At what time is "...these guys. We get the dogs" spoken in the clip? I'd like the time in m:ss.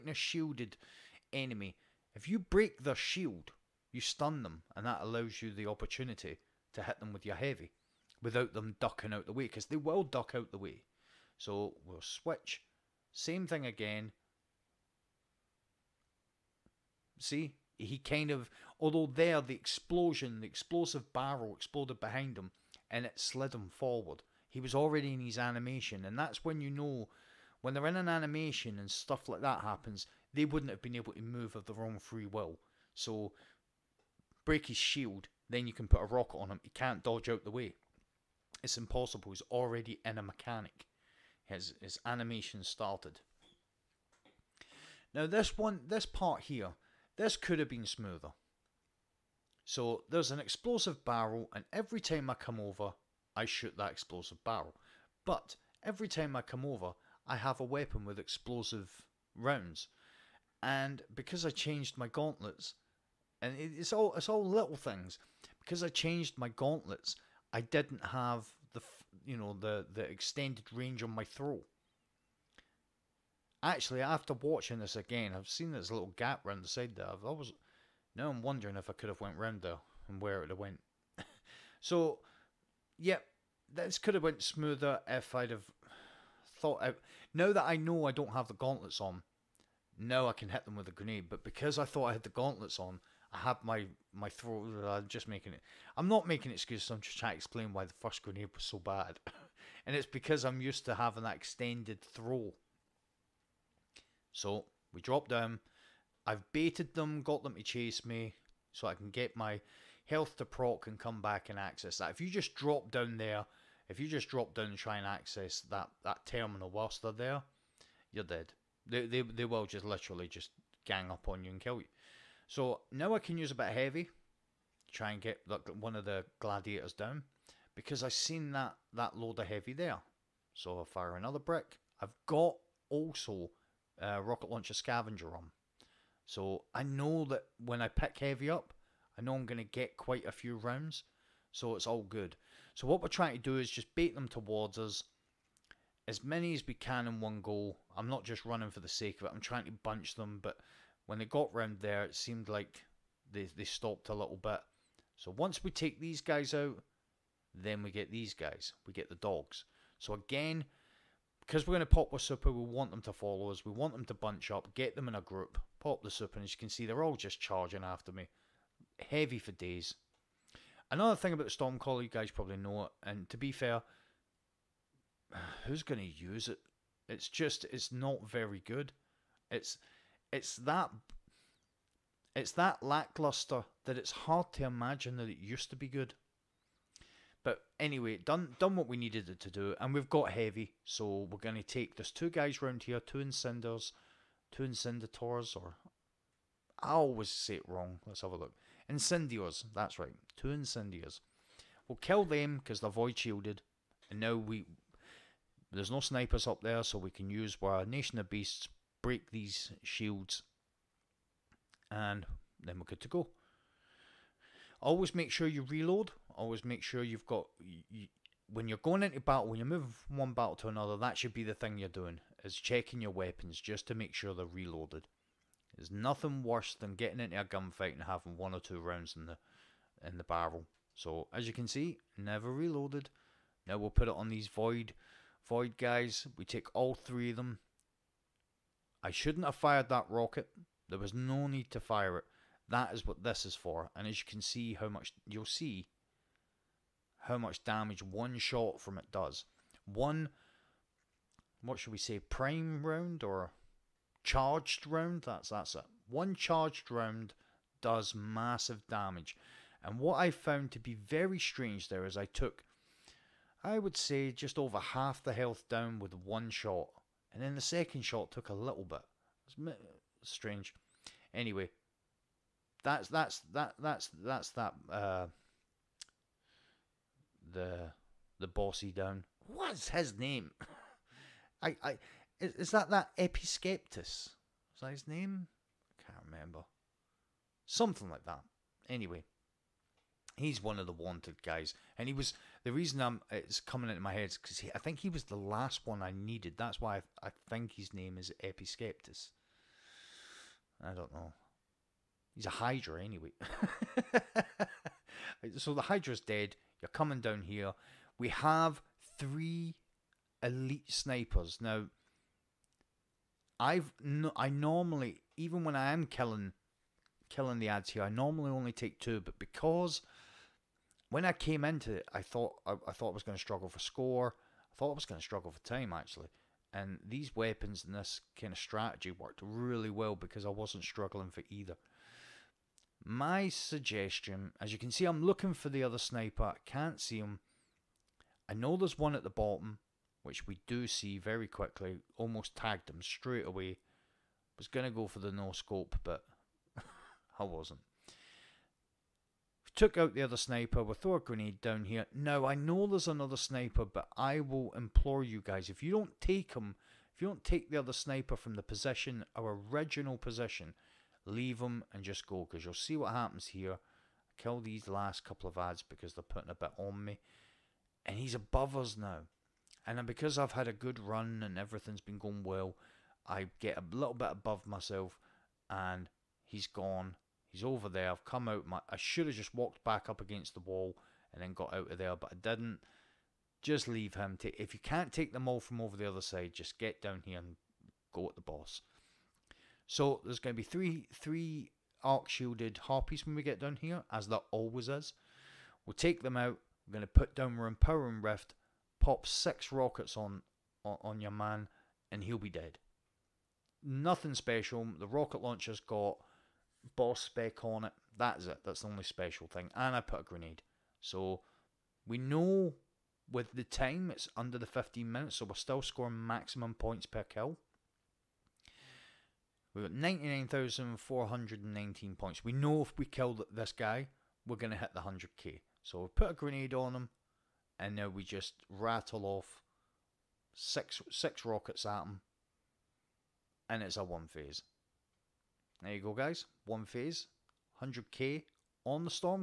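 2:38.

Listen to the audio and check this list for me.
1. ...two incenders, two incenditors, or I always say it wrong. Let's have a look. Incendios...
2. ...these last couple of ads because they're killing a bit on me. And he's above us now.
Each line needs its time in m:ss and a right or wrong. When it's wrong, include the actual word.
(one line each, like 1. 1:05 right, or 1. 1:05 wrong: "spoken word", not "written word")
1. 3:12 right
2. 6:04 wrong: "putting", not "killing".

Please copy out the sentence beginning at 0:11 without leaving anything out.
So we'll switch, same thing again.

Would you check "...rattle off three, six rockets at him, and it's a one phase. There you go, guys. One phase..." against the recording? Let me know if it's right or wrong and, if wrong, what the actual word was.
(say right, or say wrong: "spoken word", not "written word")
wrong: "six", not "three".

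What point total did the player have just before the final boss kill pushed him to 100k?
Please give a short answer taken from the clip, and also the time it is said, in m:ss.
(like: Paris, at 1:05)
99,419, at 6:59.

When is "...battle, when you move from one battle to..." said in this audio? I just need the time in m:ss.
3:39.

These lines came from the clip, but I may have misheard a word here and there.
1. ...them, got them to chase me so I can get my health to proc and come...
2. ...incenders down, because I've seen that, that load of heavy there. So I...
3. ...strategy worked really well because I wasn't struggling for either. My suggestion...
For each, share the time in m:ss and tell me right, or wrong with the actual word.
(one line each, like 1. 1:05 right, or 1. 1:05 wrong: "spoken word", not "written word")
1. 1:46 right
2. 2:06 wrong: "gladiators", not "incenders"
3. 5:28 right.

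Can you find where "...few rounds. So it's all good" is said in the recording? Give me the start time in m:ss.
2:20.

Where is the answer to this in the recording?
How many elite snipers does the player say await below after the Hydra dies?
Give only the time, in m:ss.
5:09.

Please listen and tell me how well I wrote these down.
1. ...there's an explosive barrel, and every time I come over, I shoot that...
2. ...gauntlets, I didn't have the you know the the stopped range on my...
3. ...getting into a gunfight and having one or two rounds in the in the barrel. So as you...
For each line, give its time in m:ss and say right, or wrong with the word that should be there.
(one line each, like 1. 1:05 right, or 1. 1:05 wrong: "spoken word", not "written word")
1. 0:50 right
2. 1:06 wrong: "extended", not "stopped"
3. 3:46 right.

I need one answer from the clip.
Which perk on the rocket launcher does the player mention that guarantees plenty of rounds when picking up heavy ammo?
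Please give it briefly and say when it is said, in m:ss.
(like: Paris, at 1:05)
Scavenger, at 2:14.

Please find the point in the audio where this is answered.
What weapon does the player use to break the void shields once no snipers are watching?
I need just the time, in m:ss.
3:27.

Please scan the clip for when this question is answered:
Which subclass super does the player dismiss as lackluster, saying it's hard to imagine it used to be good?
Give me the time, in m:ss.
2:51.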